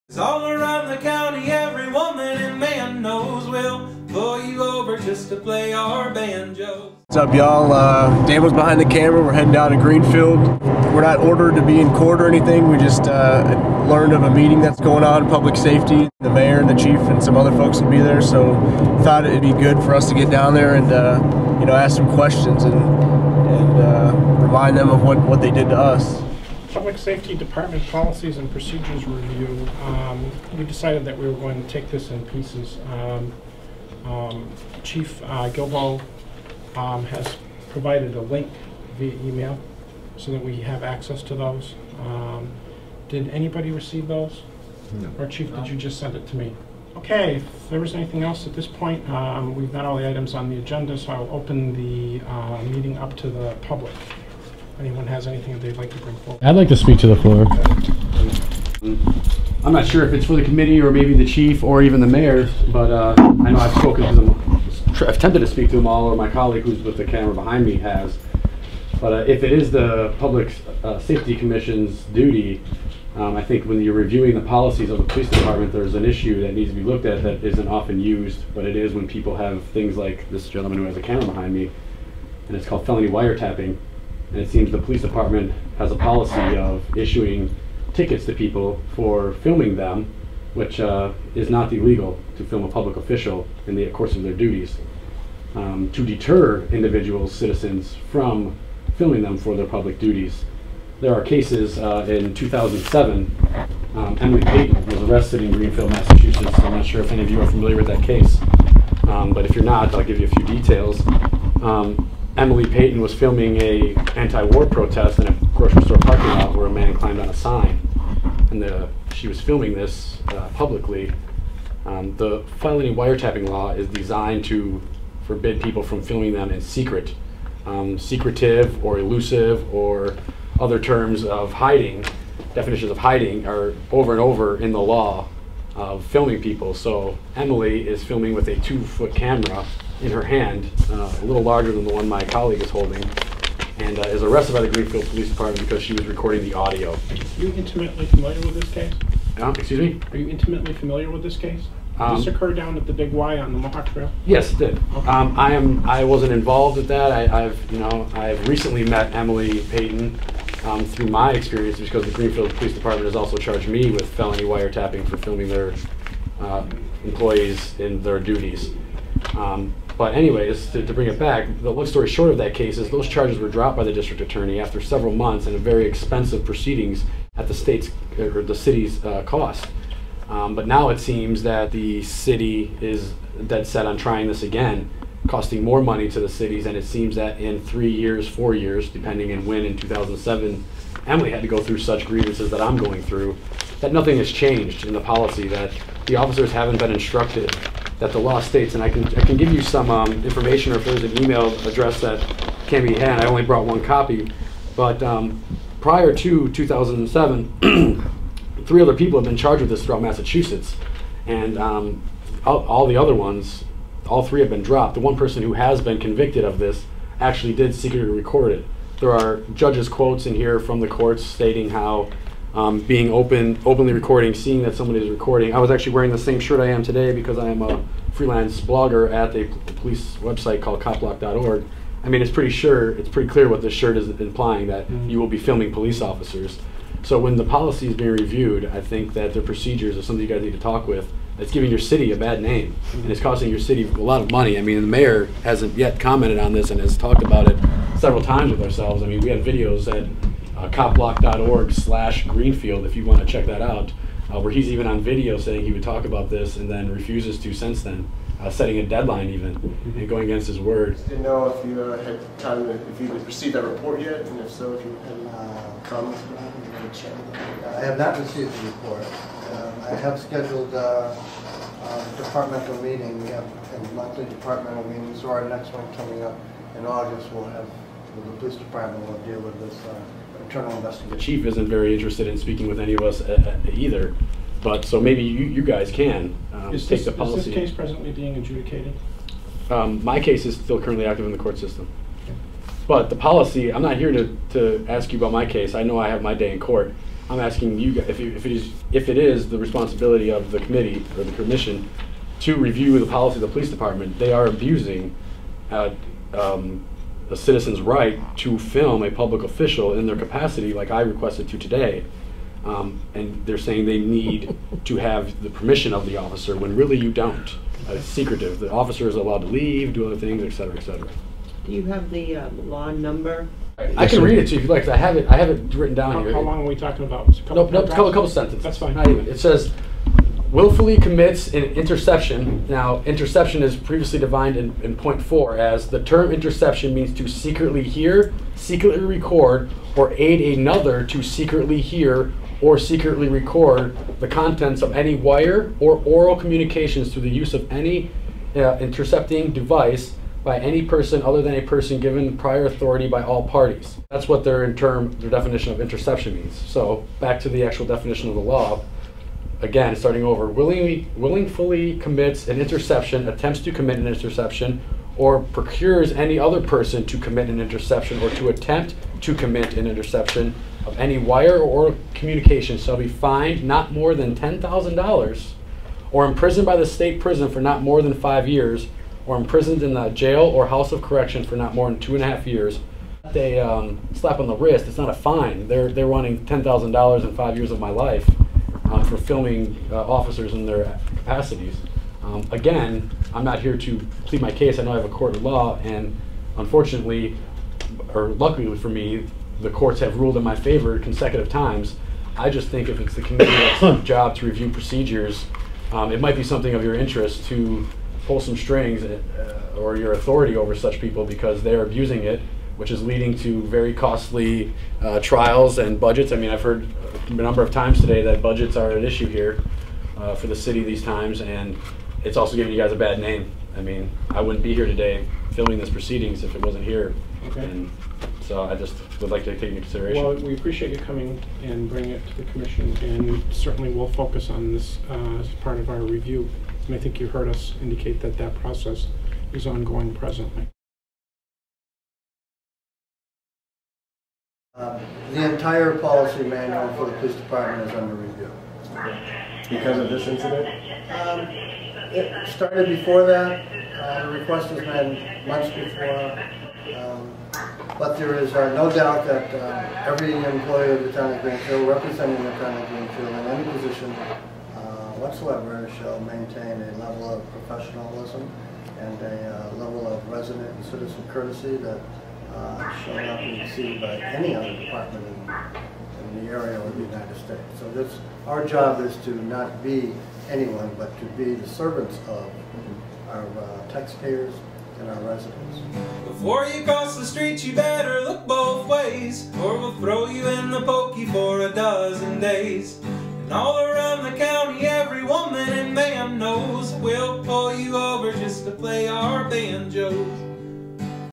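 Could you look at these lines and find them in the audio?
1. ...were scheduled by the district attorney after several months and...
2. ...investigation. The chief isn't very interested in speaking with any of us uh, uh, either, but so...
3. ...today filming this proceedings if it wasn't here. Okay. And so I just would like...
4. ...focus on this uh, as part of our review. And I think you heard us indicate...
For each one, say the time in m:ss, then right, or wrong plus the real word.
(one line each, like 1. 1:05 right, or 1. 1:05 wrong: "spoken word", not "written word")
1. 2:53 wrong: "dropped", not "scheduled"
2. 4:40 right
3. 7:04 right
4. 7:14 right.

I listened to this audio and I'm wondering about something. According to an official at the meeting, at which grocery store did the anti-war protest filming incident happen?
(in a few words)
Big Y.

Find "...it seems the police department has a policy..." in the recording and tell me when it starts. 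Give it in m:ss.
1:24.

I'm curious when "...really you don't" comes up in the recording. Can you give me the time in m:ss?
5:16.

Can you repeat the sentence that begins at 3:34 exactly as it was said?
The one person who has been convicted of this actually did secretly record it.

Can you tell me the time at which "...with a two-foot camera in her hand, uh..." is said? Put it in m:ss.
2:18.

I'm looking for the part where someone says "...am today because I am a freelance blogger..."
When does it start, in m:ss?
3:46.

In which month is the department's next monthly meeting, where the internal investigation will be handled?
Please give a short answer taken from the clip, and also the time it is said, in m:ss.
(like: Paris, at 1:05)
August, at 4:36.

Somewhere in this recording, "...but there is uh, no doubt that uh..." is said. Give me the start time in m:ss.
7:37.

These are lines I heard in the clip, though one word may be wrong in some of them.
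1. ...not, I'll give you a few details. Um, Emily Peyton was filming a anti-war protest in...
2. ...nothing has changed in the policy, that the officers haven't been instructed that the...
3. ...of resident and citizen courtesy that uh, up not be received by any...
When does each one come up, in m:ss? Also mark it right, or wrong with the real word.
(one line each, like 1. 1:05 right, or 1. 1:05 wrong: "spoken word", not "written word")
1. 1:49 right
2. 3:13 right
3. 7:50 right.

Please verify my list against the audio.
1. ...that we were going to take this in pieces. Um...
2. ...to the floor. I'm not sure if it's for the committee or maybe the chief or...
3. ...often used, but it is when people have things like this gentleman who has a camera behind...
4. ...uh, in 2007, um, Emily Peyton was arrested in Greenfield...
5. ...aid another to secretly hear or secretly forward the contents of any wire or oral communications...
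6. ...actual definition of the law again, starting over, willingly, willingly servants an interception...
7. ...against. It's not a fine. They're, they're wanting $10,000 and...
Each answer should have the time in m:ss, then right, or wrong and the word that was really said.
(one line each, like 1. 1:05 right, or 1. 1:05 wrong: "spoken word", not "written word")
1. 0:31 right
2. 0:56 right
3. 1:17 right
4. 1:41 right
5. 5:40 wrong: "record", not "forward"
6. 5:57 wrong: "commits", not "servants"
7. 6:24 wrong: "wrist", not "against".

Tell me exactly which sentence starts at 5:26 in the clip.
How long are we talking about?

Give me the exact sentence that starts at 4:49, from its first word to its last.
Um, my case is still currently active in the court system.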